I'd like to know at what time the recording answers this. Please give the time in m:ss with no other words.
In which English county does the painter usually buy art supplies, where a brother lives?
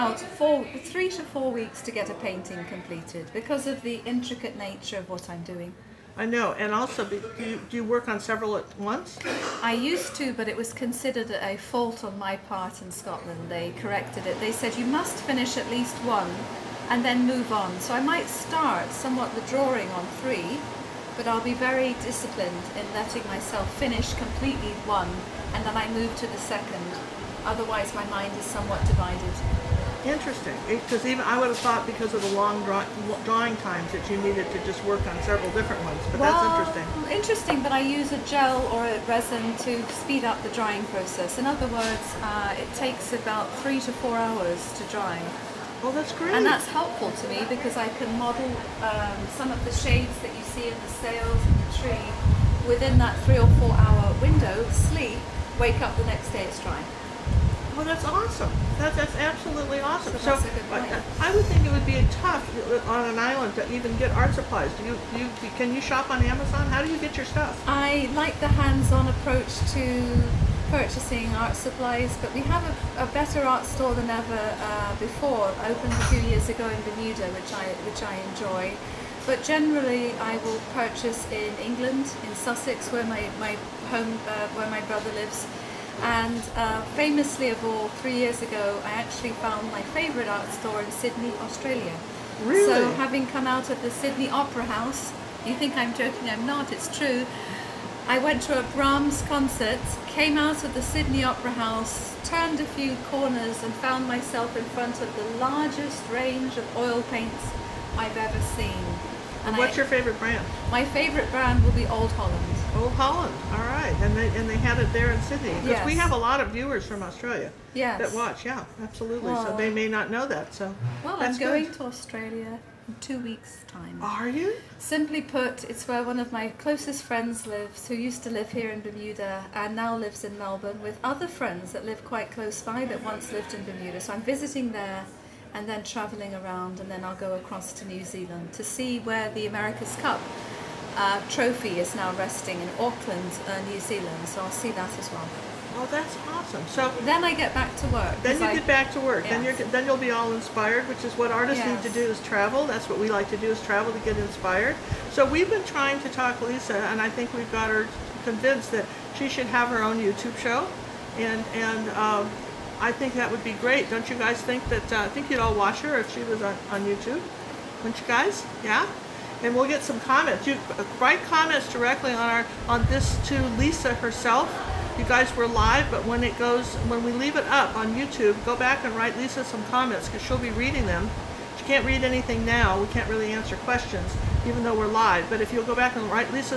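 1:22.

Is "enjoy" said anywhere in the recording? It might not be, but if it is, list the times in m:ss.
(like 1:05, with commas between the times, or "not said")
1:18.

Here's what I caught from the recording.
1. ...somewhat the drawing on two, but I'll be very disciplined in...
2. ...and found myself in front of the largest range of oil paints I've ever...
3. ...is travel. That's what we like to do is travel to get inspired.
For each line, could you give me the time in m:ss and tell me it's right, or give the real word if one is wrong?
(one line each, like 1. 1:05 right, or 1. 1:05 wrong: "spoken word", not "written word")
1. 0:18 wrong: "three", not "two"
2. 1:43 right
3. 2:32 right.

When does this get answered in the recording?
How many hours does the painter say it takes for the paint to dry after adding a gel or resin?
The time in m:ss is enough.
0:43.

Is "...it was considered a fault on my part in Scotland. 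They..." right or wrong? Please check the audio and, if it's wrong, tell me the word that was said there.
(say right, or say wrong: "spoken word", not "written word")
right.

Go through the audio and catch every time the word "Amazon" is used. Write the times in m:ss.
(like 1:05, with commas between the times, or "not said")
1:06.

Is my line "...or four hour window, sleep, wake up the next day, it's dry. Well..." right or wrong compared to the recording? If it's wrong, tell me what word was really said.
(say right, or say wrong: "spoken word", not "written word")
right.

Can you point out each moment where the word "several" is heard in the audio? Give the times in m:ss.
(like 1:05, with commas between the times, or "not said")
0:08, 0:35.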